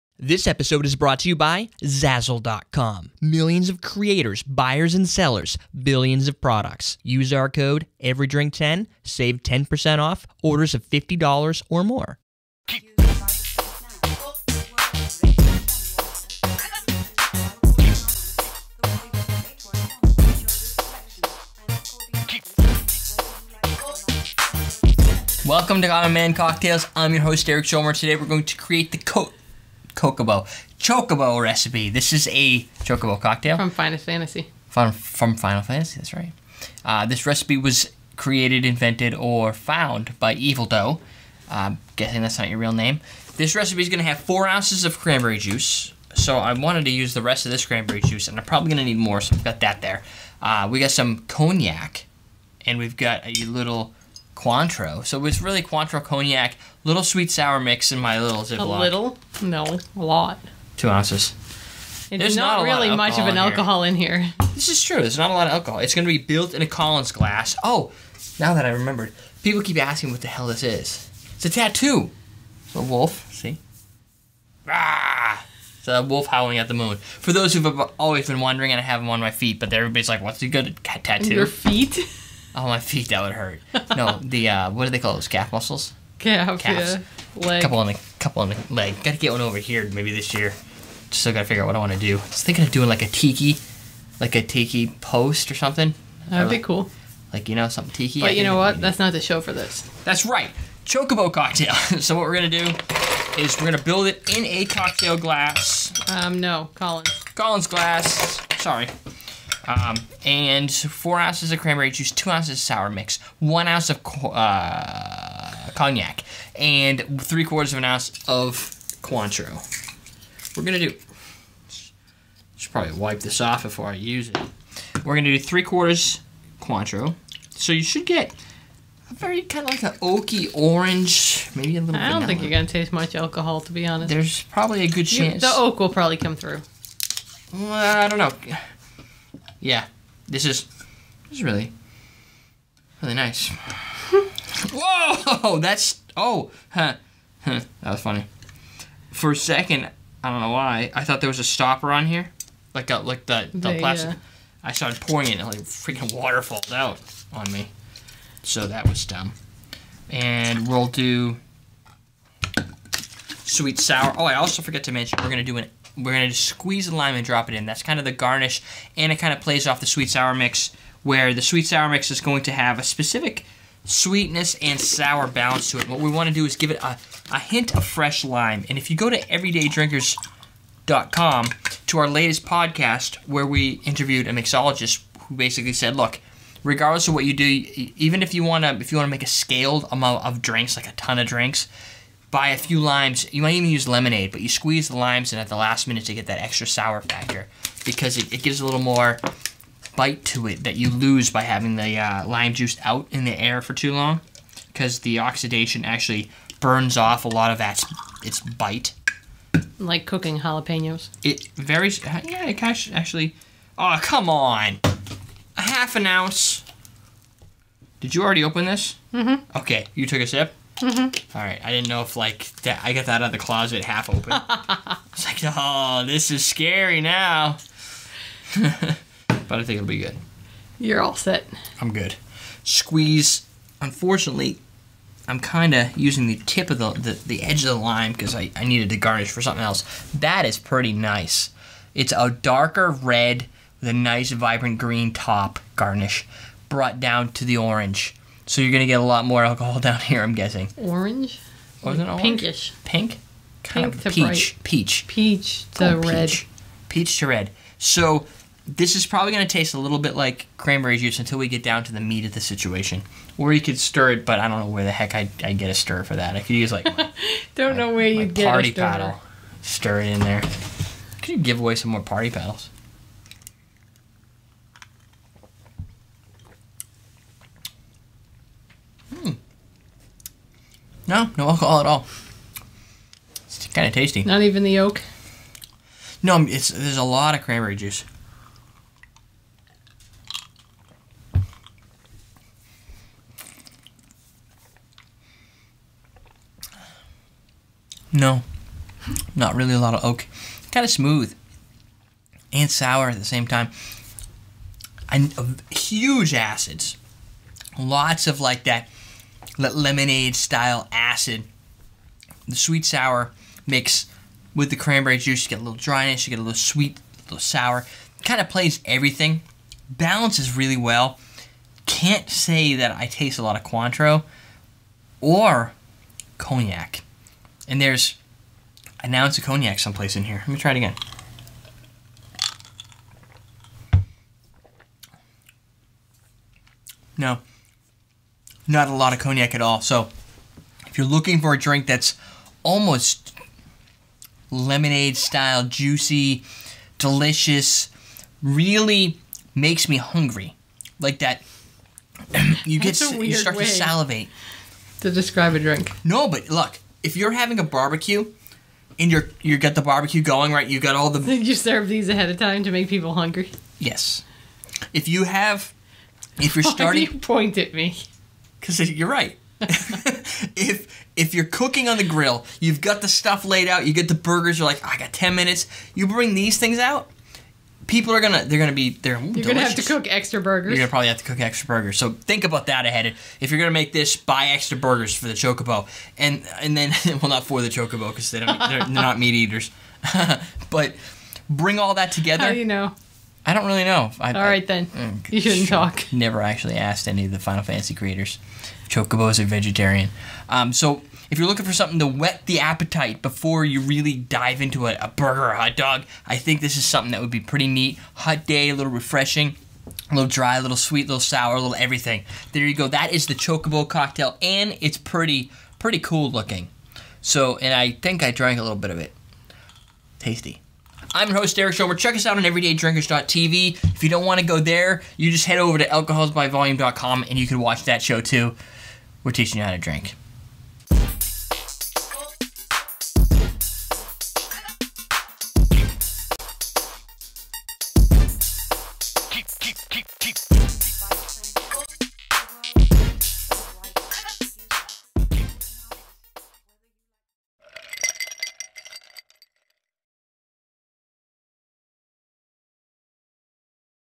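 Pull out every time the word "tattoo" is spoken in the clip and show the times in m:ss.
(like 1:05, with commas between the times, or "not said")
1:11, 1:20.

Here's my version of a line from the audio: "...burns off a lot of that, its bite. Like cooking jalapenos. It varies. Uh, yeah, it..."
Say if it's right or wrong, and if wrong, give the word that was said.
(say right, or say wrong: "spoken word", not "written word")
right.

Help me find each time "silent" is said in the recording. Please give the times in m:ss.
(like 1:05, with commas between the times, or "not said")
not said.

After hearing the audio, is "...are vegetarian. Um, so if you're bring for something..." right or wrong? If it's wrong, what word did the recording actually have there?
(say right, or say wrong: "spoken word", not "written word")
wrong: "looking", not "bring".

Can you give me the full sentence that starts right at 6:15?
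You bring these things out, people are gonna they're gonna be they're you're delicious.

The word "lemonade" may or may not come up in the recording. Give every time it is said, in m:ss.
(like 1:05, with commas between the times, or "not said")
3:13, 5:09, 5:44.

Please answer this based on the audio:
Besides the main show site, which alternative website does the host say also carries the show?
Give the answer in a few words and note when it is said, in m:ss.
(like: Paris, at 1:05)
alcoholsbyvolume.com, at 7:05.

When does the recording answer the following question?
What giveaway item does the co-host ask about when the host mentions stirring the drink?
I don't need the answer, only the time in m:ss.
4:32.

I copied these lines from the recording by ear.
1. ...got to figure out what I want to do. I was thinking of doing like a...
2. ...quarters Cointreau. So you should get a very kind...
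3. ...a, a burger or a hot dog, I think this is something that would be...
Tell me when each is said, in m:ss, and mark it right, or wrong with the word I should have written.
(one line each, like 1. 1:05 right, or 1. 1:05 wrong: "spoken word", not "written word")
1. 1:31 right
2. 2:05 right
3. 6:44 right.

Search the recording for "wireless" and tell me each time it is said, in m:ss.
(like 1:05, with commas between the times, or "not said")
not said.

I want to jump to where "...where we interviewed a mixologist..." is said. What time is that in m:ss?
3:03.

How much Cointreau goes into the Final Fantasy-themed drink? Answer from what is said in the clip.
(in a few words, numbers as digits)
3/4 ounce.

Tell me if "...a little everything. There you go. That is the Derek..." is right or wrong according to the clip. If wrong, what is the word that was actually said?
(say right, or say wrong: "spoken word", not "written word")
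wrong: "Chocobo", not "Derek".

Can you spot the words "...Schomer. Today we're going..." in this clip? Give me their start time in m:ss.
0:27.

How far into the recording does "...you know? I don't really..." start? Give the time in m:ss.
6:32.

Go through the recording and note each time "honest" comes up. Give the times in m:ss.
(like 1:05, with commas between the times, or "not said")
2:13.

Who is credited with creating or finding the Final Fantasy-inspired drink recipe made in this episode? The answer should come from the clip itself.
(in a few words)
Evil Doe.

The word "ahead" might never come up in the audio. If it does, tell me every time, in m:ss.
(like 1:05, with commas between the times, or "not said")
6:02, 6:22.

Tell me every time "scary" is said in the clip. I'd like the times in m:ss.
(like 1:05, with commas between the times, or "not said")
3:46.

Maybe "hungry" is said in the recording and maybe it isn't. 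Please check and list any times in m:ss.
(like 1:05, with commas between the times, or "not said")
5:49, 6:03.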